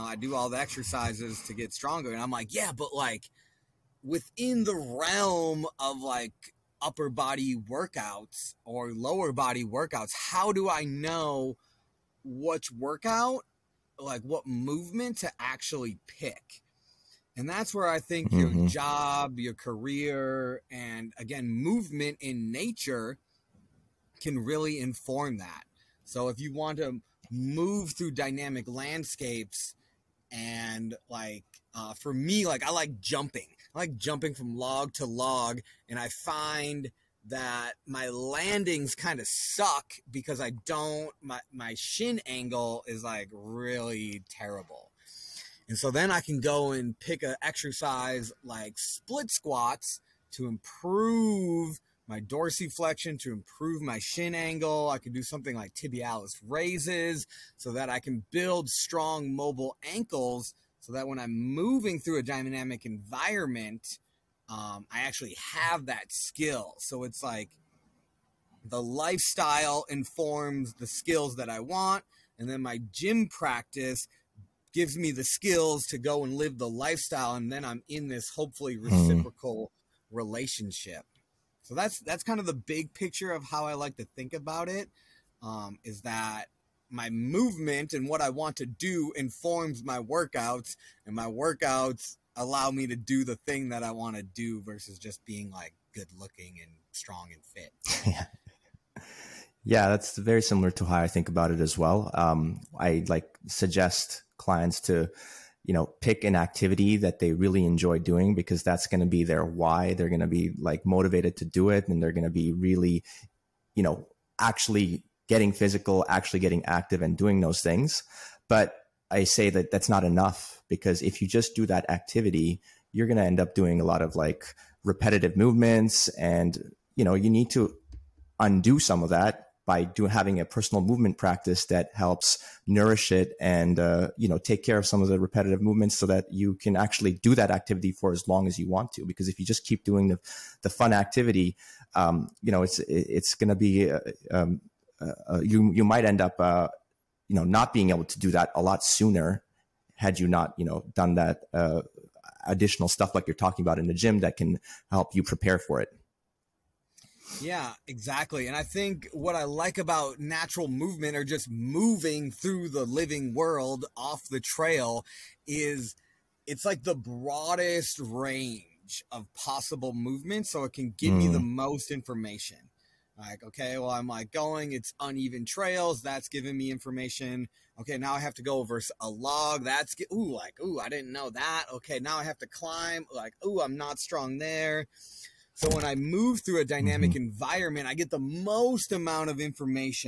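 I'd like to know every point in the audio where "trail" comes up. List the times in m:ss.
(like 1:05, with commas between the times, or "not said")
2:44, 2:55.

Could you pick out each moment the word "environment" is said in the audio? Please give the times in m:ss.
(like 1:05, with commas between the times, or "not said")
1:02, 3:07.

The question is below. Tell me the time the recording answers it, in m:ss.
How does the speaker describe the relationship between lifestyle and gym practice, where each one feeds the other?
1:18.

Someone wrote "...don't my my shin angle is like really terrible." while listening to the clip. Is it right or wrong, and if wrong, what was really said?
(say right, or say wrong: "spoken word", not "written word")
right.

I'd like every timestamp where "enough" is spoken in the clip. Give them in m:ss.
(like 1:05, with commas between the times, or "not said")
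2:00.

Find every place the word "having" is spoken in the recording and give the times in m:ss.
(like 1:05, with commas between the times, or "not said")
2:10.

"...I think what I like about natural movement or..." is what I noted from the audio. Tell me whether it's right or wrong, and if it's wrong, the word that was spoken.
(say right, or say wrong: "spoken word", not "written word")
right.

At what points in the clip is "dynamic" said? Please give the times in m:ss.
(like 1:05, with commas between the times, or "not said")
0:28, 1:02, 3:06.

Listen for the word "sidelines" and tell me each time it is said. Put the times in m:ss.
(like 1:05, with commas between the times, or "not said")
not said.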